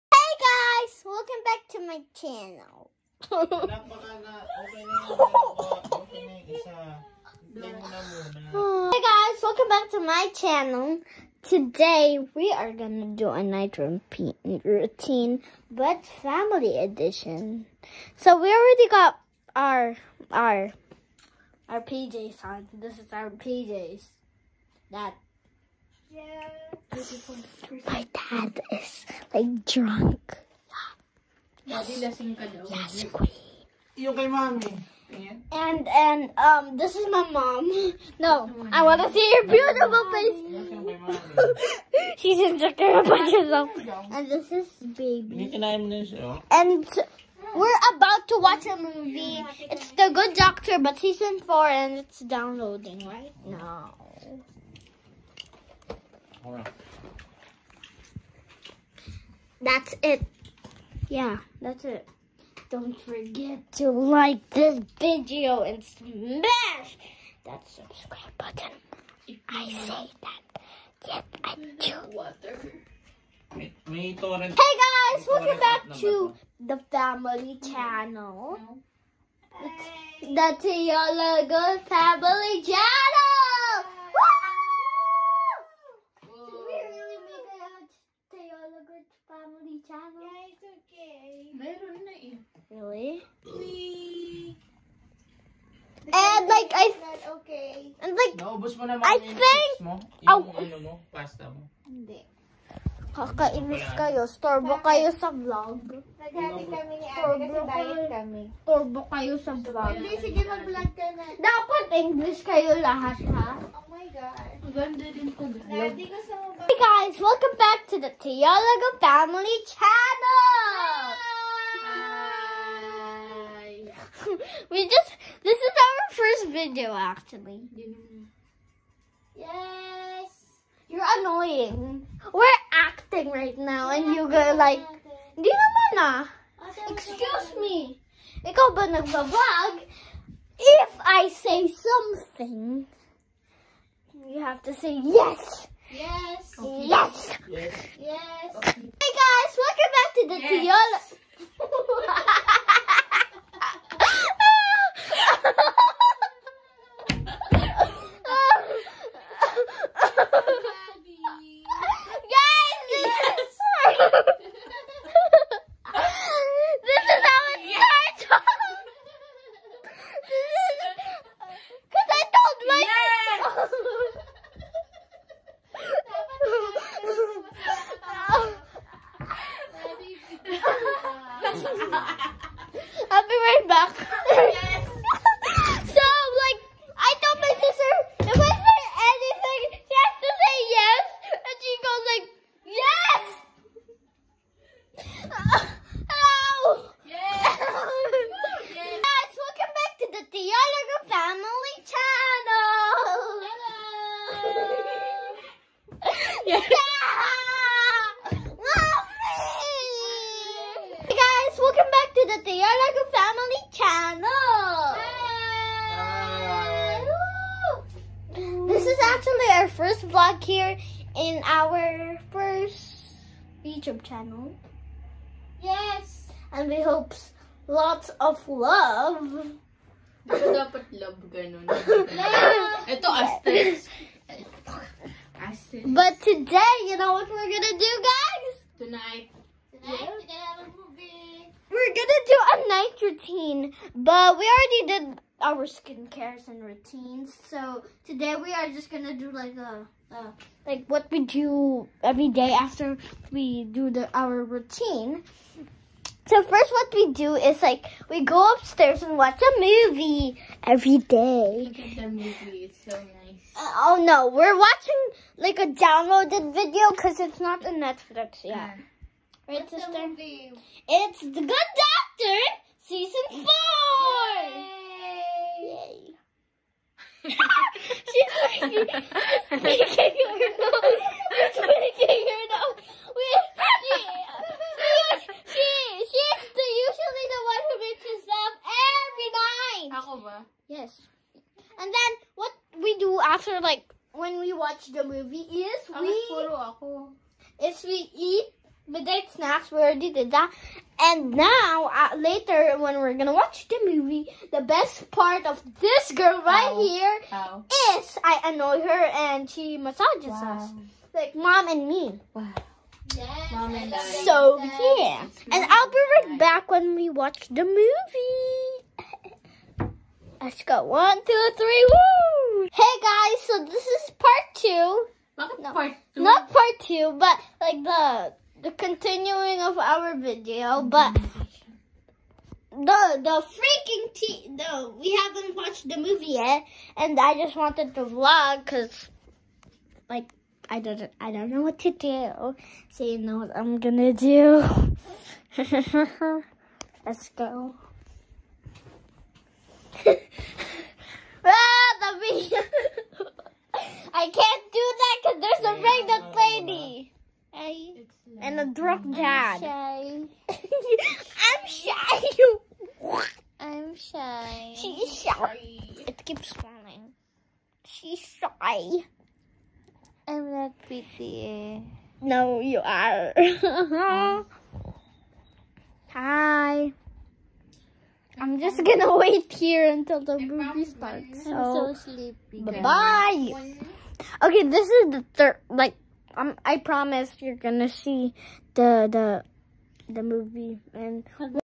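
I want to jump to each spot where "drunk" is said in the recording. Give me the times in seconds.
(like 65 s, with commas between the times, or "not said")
29 s, 358 s.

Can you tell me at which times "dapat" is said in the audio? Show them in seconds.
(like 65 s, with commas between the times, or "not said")
111 s, 230 s.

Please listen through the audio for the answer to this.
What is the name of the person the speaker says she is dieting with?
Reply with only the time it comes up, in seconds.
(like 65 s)
107 s.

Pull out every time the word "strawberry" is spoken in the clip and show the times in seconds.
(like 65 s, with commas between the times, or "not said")
not said.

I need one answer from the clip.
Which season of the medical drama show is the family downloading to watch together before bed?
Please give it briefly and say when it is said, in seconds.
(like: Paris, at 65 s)
Season 4, at 50 s.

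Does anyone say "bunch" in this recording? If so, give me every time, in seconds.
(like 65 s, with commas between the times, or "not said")
43 s.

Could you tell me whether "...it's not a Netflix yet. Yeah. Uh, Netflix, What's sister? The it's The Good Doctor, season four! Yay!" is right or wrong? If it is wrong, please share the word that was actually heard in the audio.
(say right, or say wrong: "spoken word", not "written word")
wrong: "Right", not "Netflix".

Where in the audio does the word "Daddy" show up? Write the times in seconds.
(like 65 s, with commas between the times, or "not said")
31 s, 115 s.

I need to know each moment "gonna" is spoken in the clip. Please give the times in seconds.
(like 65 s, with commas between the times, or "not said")
12 s, 237 s, 241 s, 248 s, 303 s, 343 s, 378 s, 387 s.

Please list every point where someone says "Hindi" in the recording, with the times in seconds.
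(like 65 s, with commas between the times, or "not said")
101 s, 109 s.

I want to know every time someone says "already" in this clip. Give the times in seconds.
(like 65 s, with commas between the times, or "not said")
18 s, 244 s, 299 s.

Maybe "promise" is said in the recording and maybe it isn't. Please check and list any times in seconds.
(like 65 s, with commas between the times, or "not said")
386 s.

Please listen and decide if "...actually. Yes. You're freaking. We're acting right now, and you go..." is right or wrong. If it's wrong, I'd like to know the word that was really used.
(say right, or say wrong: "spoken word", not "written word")
wrong: "annoying", not "freaking".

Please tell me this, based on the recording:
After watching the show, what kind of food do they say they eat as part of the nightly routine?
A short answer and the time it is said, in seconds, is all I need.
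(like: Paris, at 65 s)
midnight snacks, at 298 s.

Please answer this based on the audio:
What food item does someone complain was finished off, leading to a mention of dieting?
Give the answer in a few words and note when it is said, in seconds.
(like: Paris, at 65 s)
pasta, at 101 s.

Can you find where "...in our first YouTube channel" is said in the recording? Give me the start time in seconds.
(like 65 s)
221 s.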